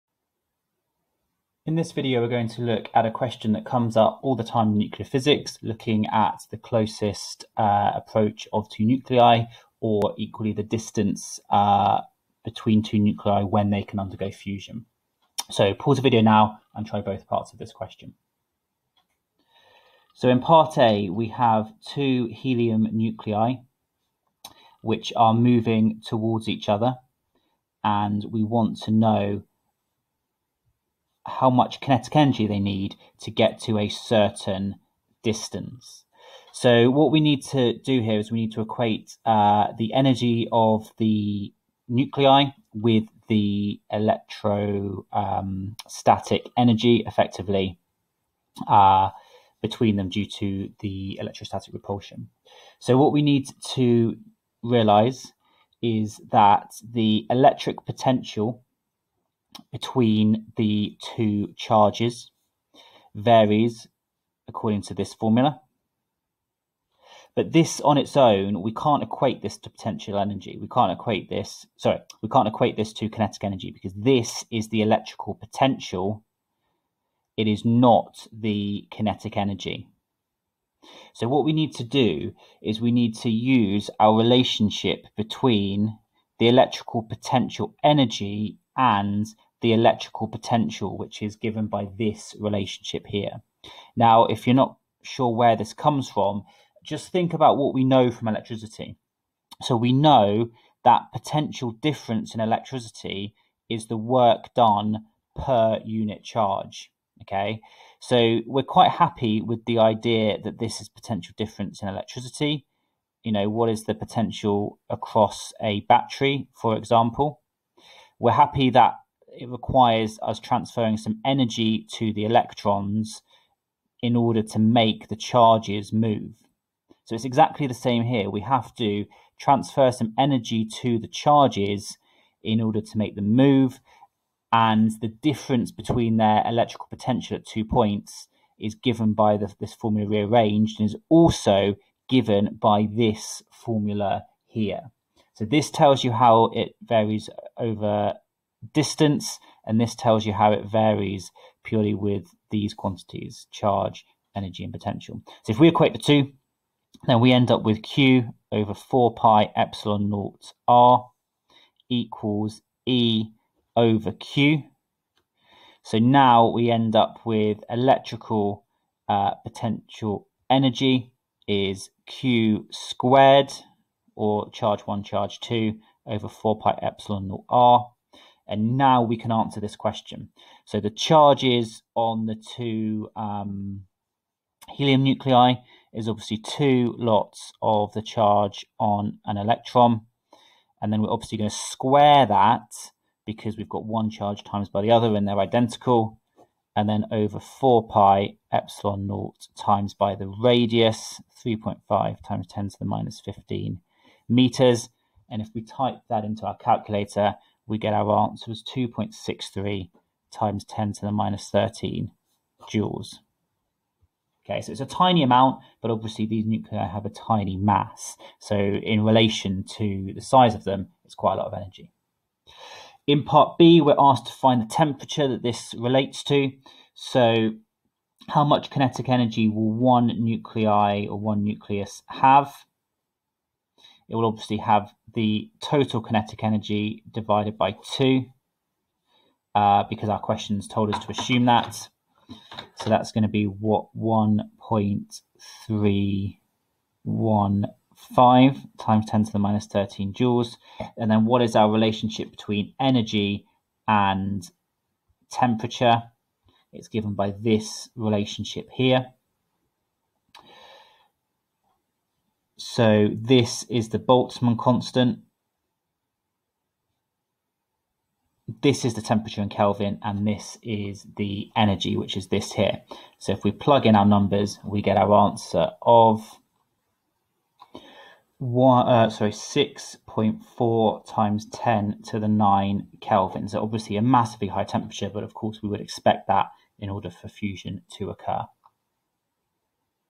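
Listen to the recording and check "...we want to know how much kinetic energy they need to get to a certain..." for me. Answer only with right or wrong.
right.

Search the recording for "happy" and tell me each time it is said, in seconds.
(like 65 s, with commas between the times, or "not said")
108 s, 118 s.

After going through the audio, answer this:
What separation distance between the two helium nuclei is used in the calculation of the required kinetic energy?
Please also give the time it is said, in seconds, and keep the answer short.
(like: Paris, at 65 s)
3.5 × 10^-15 m, at 201 s.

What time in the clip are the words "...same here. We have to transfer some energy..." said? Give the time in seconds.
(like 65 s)
127 s.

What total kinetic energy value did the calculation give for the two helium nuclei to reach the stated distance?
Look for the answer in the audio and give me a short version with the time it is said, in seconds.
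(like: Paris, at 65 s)
2.63 × 10^-13 J, at 208 s.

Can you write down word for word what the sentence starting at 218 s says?
So in relation to the size of them, it's quite a lot of energy.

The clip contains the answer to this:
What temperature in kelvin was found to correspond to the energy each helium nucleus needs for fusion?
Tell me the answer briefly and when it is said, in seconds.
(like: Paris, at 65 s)
6.4 × 10^9 K, at 279 s.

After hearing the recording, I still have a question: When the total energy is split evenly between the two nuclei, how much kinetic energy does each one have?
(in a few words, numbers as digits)
1.315 × 10^-13 J.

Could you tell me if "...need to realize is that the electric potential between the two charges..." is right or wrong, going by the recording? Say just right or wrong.
right.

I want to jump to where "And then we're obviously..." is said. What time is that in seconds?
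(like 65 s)
190 s.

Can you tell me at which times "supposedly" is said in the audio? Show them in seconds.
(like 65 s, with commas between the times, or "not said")
not said.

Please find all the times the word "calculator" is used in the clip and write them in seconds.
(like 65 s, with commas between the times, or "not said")
206 s.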